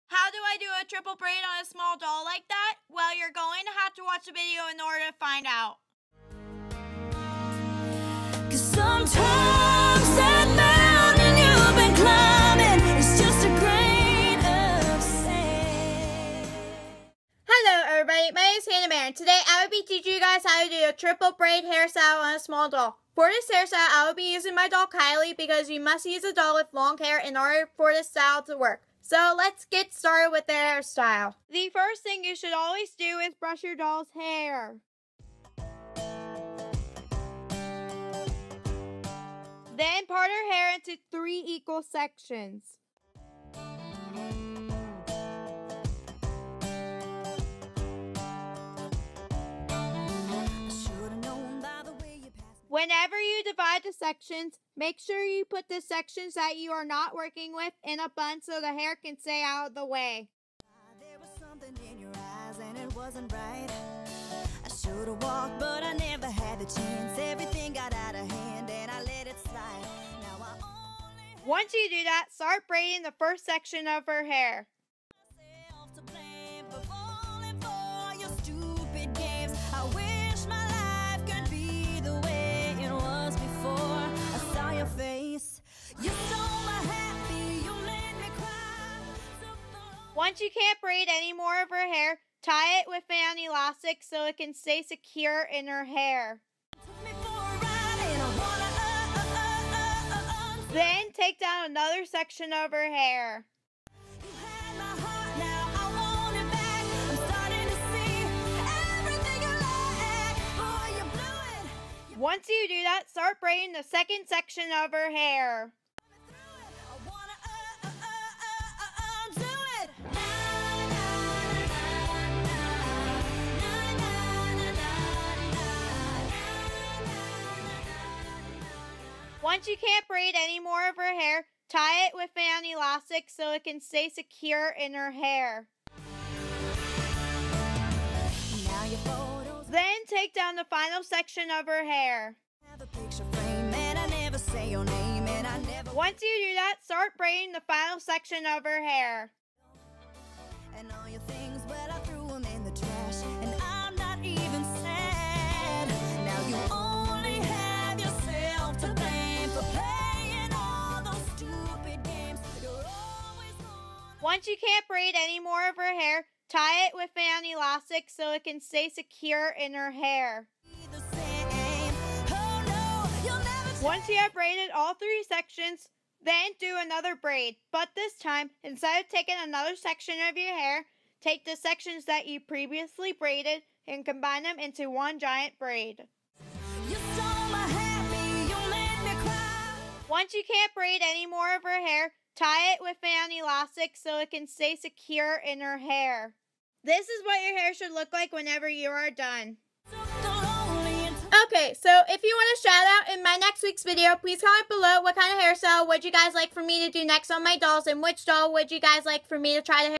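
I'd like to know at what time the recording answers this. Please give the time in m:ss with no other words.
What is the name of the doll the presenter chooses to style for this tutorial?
0:24.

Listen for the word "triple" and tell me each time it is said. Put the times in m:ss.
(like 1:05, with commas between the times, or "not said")
0:00, 0:20.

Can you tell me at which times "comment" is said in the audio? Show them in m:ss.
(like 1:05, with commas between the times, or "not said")
3:24.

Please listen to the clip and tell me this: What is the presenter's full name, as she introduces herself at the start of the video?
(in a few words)
Hannah Barron.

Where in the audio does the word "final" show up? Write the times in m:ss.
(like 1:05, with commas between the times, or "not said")
2:20, 2:27.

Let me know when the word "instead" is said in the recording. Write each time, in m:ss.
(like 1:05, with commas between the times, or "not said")
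2:58.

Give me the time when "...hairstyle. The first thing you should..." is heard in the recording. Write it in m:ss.
0:30.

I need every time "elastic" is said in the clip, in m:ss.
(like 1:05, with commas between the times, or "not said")
1:33, 2:12, 2:47, 3:13.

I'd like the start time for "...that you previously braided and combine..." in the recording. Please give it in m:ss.
3:02.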